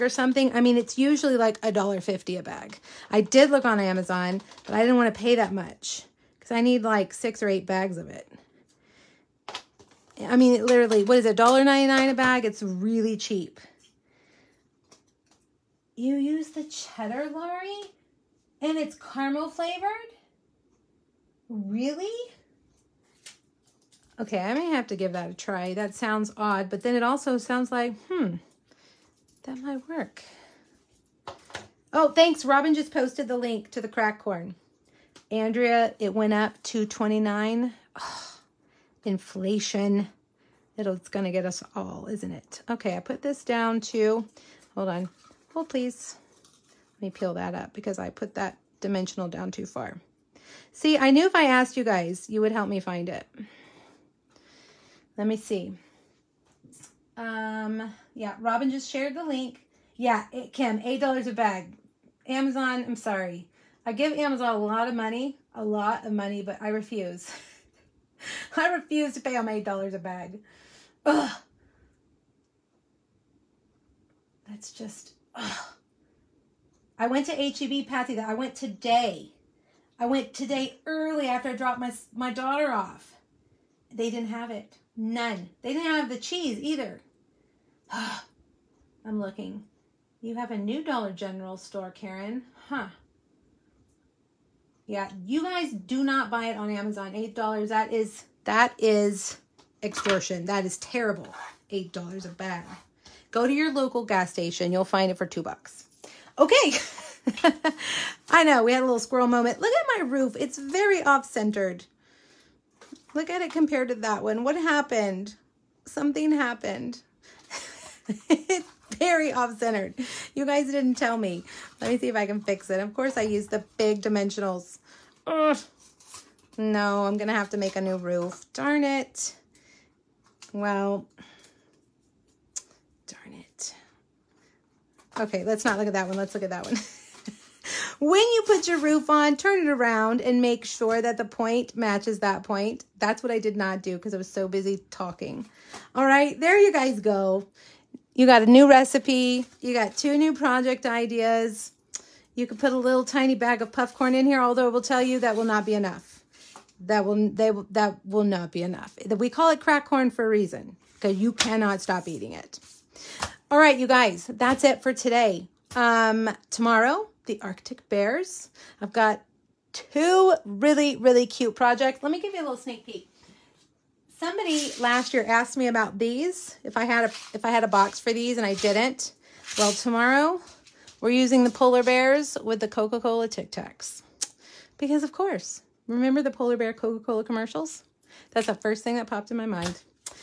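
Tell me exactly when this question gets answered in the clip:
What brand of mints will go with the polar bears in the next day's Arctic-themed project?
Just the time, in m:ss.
3:03.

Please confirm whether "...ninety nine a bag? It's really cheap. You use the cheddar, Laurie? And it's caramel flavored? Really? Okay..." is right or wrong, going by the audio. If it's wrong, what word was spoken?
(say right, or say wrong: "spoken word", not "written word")
right.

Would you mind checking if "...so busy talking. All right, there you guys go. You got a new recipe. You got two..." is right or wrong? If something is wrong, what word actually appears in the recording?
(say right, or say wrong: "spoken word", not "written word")
right.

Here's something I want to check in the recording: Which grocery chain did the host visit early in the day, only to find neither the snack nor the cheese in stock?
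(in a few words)
HEB.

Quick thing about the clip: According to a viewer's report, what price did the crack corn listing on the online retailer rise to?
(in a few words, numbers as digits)
29.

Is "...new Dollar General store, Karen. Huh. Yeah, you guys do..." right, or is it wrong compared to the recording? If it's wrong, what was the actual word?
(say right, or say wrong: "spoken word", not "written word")
right.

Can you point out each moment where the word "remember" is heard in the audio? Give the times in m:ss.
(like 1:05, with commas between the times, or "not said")
3:05.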